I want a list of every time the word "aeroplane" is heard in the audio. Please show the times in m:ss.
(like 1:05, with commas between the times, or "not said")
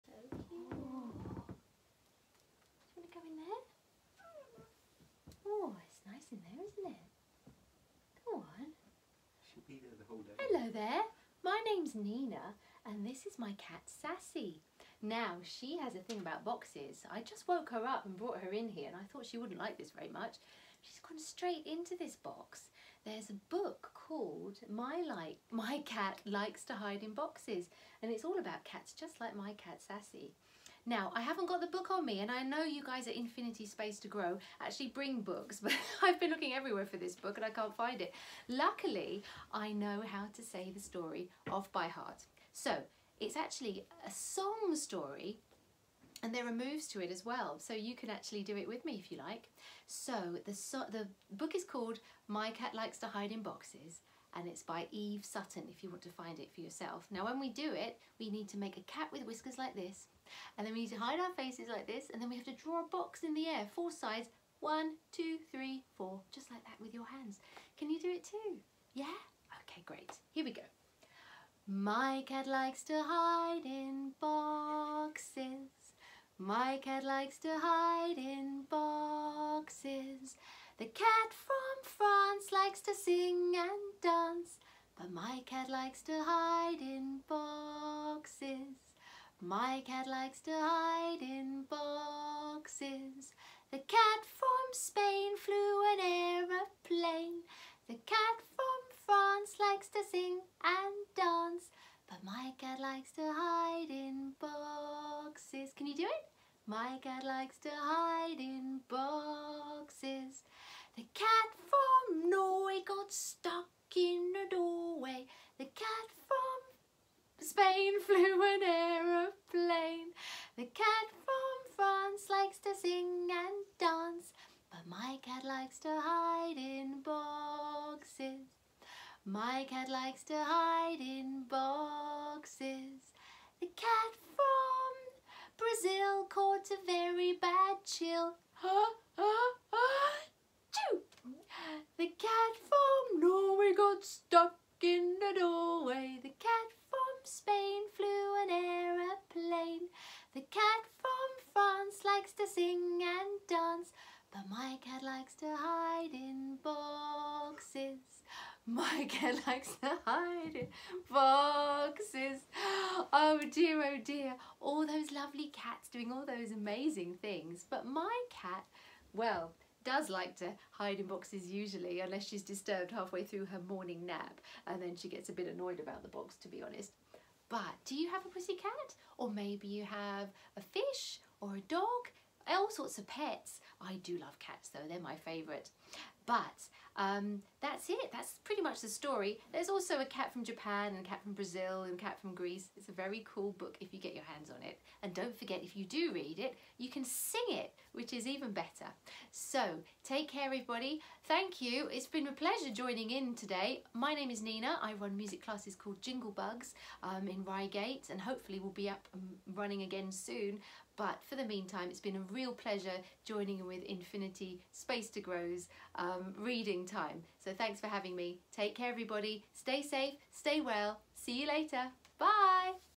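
1:36, 1:58.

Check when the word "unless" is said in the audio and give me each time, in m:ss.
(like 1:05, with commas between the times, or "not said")
2:51.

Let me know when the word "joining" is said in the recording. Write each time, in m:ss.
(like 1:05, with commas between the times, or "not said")
3:22, 3:33.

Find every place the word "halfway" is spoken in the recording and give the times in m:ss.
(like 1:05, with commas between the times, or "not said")
2:52.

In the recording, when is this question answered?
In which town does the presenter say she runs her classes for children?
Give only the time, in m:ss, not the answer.
3:27.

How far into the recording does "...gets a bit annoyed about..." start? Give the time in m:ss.
2:55.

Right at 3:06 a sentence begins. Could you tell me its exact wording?
But um, that's it, that's pretty much the story.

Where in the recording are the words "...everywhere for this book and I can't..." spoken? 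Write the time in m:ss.
0:36.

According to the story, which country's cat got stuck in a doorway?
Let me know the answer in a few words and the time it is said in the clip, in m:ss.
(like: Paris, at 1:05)
Norway, at 1:52.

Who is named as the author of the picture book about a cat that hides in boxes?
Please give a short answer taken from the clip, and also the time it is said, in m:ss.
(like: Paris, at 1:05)
Eve Sutton, at 0:54.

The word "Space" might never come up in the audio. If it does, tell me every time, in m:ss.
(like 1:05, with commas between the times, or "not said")
0:33, 3:34.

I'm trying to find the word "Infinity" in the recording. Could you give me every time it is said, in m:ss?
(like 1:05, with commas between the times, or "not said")
0:33, 3:33.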